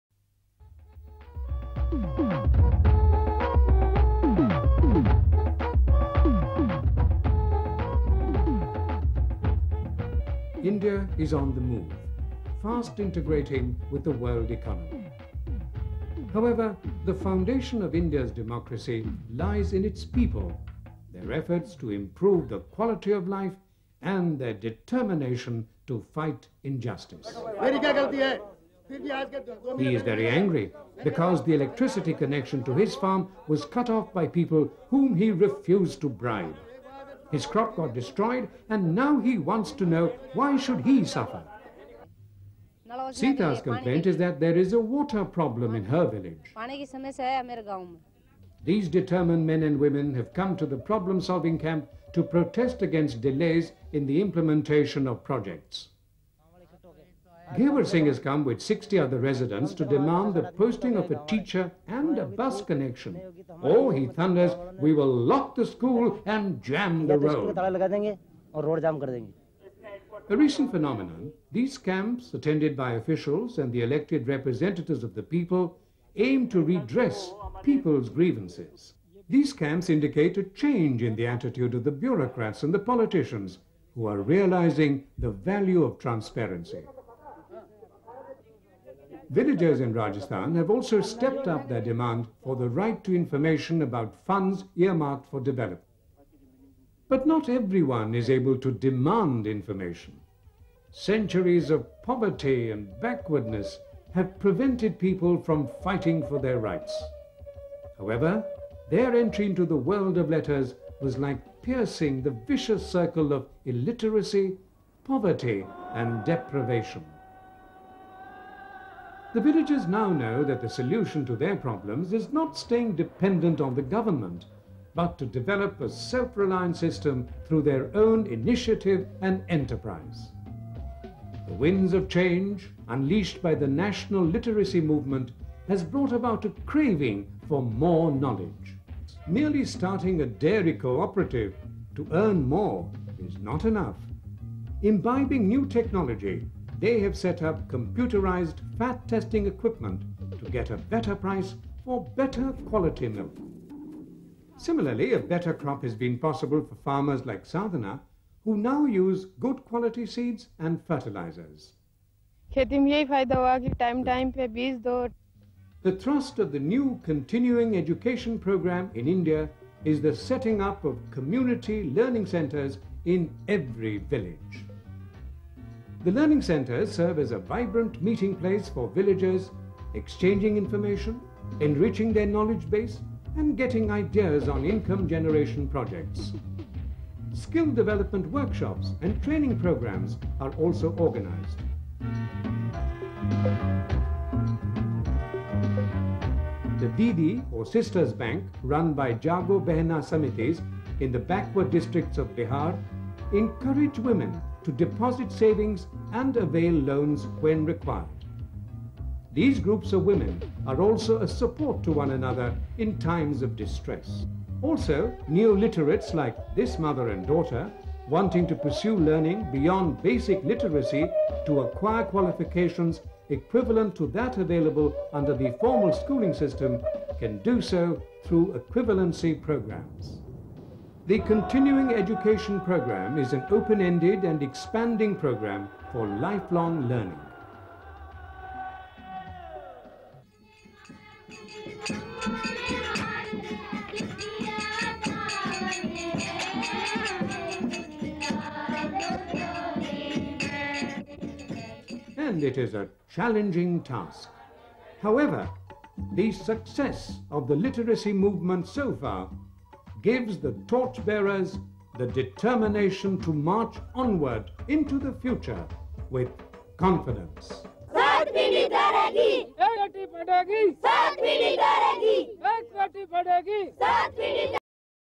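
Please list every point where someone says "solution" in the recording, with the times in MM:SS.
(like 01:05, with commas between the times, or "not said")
02:00.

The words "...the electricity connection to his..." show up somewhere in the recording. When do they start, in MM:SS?
00:31.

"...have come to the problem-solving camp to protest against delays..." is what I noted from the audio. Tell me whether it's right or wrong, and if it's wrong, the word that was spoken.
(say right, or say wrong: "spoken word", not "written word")
right.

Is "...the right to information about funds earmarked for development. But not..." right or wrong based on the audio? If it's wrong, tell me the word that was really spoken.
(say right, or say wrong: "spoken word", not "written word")
right.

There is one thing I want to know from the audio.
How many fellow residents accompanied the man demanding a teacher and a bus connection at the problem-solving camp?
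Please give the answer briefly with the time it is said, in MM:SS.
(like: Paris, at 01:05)
60, at 00:58.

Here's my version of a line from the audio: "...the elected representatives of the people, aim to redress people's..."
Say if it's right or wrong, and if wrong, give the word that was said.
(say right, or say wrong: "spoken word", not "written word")
right.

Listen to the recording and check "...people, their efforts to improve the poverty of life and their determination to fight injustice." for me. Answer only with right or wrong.
wrong.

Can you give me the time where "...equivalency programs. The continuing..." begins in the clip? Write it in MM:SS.
03:48.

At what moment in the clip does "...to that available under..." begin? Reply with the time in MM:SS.
03:43.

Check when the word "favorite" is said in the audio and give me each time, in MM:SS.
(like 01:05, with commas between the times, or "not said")
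not said.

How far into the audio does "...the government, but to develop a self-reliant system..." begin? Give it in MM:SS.
02:03.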